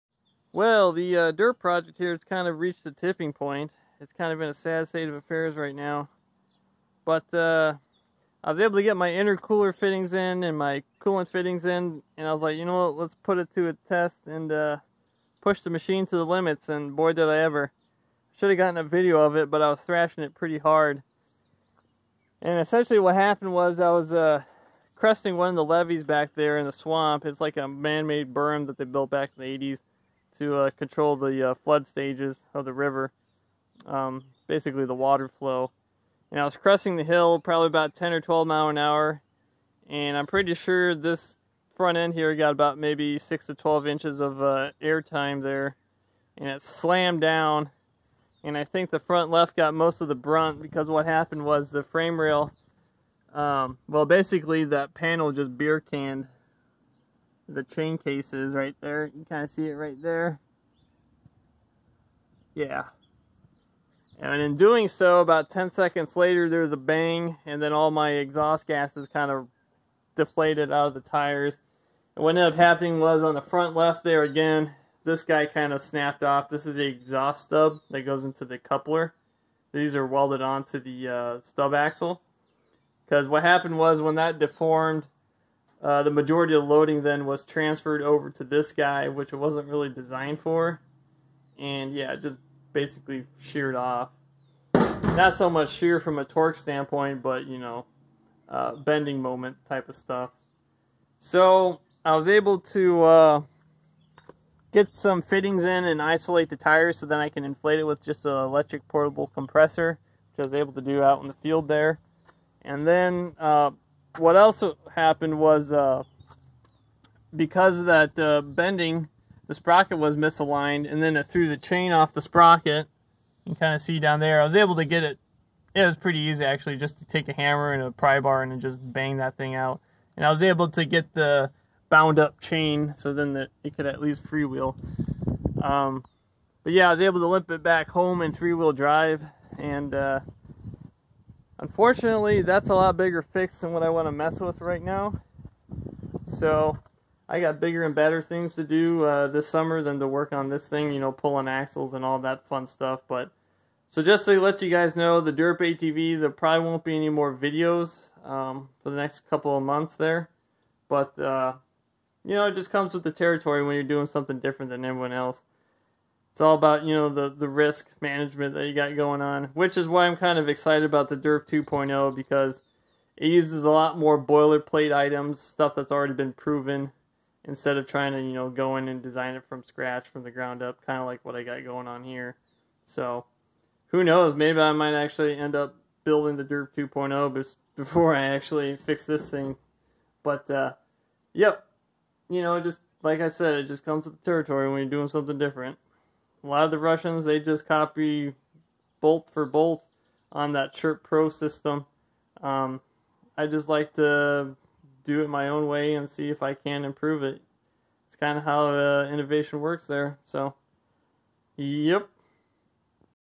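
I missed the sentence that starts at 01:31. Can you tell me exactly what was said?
And yeah, just basically sheared off.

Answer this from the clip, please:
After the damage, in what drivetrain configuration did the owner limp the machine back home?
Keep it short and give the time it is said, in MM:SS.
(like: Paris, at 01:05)
three wheel drive, at 02:18.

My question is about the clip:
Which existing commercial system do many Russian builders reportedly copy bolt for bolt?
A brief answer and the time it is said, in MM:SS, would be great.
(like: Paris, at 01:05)
Sherp Pro, at 03:20.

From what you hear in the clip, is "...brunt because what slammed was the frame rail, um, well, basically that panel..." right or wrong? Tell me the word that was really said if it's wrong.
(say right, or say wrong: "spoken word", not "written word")
wrong: "happened", not "slammed".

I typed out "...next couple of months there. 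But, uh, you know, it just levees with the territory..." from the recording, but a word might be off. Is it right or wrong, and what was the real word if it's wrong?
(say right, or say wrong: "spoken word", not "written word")
wrong: "comes", not "levees".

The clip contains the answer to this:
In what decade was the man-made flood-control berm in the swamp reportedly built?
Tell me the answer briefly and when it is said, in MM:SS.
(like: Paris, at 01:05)
1980s, at 00:29.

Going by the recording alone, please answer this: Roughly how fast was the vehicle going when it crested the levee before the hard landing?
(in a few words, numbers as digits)
10 or 12 mph.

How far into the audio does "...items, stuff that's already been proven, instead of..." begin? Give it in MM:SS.
02:54.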